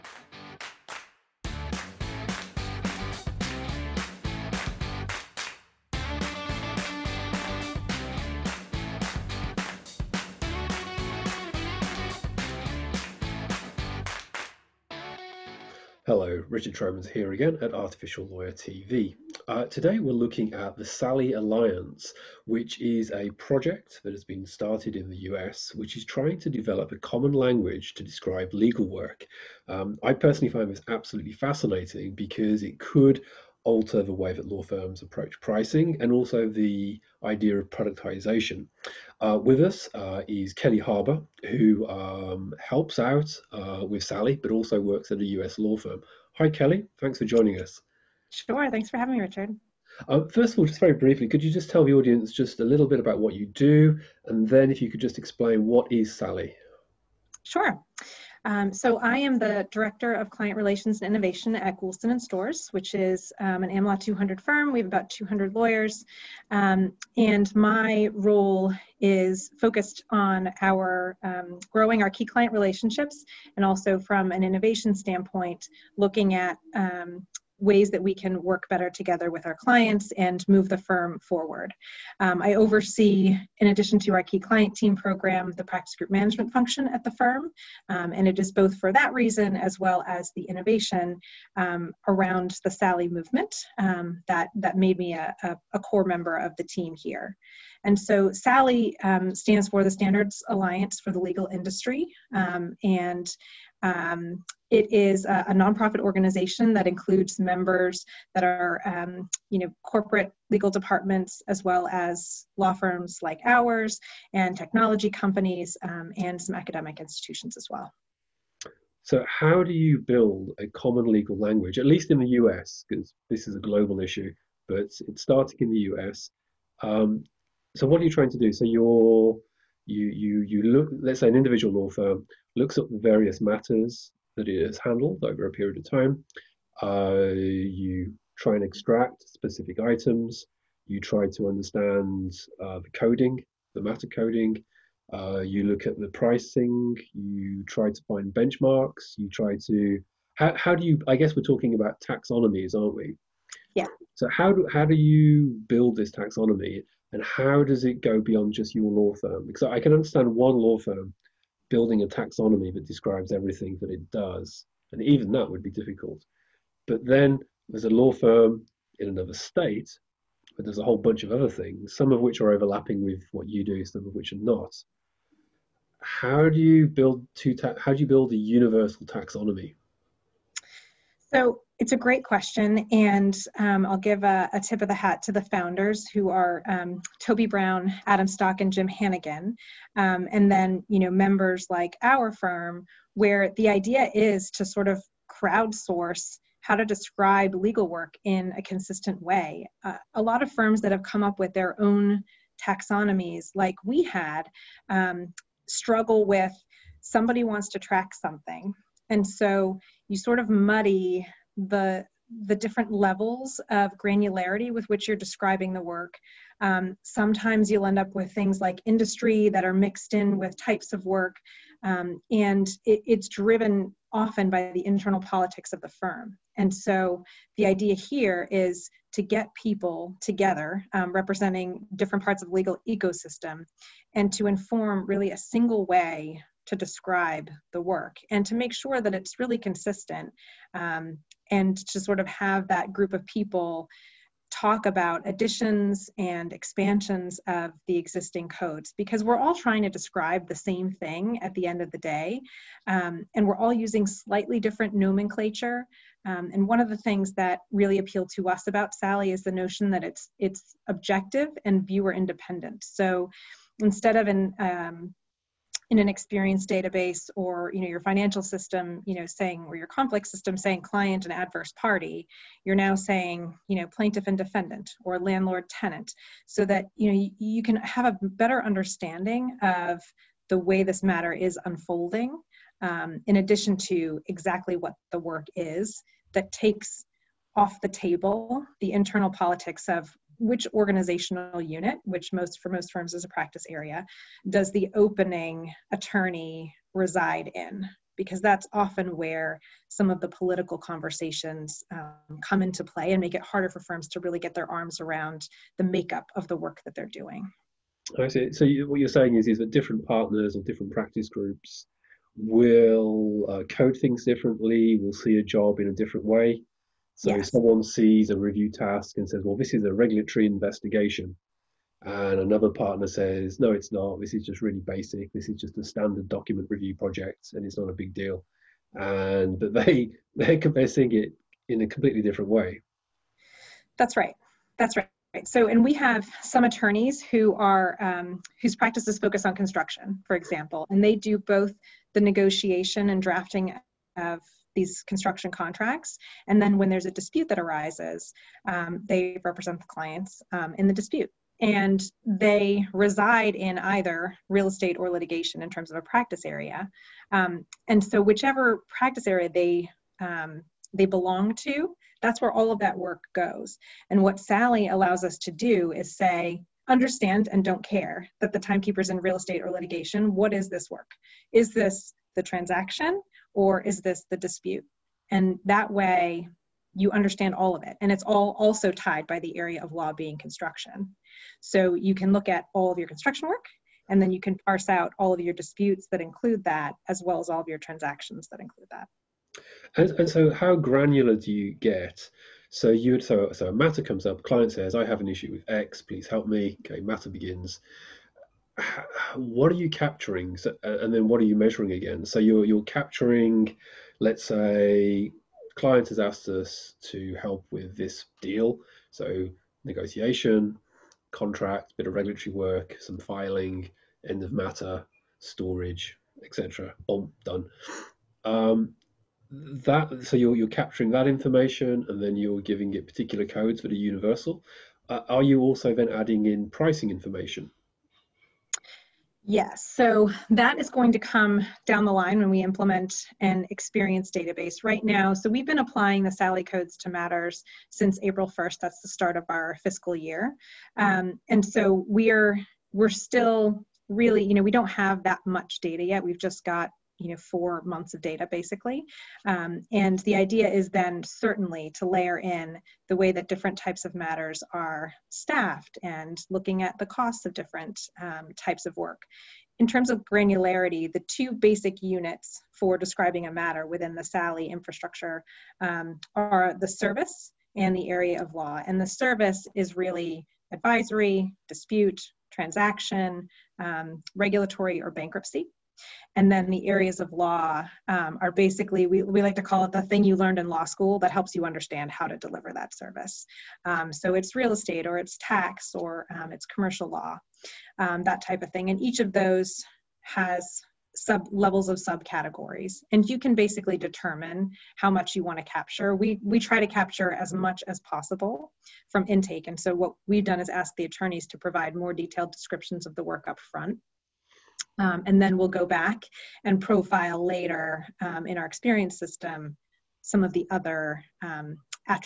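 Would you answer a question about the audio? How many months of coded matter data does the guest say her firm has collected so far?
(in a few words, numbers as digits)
4.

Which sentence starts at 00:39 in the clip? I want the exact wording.
Uh, with us uh, is Kelly Harbour, who um, helps out uh, with SALI, but also works at a US law firm.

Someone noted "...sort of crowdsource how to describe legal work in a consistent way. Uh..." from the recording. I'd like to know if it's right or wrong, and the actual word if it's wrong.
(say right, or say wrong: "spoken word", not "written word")
right.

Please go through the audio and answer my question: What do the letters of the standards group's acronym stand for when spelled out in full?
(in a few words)
Standards Alliance for the Legal Industry.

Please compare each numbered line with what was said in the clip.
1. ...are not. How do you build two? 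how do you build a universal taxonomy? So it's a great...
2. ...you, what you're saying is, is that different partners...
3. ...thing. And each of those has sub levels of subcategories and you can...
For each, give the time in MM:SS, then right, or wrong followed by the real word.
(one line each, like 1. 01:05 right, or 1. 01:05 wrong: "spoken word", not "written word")
1. 02:54 right
2. 05:08 right
3. 08:08 right.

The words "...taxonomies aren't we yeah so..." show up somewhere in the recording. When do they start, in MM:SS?
02:32.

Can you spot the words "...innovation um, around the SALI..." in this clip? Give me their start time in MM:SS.
01:30.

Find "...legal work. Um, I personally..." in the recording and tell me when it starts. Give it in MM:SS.
00:28.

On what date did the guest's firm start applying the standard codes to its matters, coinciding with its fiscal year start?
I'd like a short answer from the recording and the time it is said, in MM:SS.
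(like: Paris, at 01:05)
April 1st, at 07:18.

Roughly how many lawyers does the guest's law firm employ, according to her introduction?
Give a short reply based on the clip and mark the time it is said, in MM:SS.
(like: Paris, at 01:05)
200, at 01:04.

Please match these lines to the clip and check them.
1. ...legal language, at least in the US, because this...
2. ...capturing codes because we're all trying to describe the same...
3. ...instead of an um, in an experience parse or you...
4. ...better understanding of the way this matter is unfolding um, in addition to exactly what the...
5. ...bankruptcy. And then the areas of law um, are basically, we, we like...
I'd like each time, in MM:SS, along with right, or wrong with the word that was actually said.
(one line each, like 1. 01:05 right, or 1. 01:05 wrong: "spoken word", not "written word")
1. 02:01 right
2. 04:07 wrong: "existing", not "capturing"
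3. 04:23 wrong: "database", not "parse"
4. 04:38 right
5. 07:55 right.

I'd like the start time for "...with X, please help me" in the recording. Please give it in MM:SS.
06:35.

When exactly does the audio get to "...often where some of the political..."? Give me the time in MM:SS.
04:58.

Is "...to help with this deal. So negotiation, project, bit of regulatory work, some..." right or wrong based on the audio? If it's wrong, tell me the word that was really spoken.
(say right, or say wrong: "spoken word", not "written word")
wrong: "contract", not "project".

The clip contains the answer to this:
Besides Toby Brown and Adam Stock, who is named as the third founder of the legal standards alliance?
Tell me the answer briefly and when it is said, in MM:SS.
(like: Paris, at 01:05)
Jim Hannigan, at 03:08.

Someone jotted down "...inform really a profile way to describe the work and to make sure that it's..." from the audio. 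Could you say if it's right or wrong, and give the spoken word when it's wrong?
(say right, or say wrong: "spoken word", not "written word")
wrong: "single", not "profile".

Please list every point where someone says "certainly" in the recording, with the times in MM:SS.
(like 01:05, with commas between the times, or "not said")
07:31.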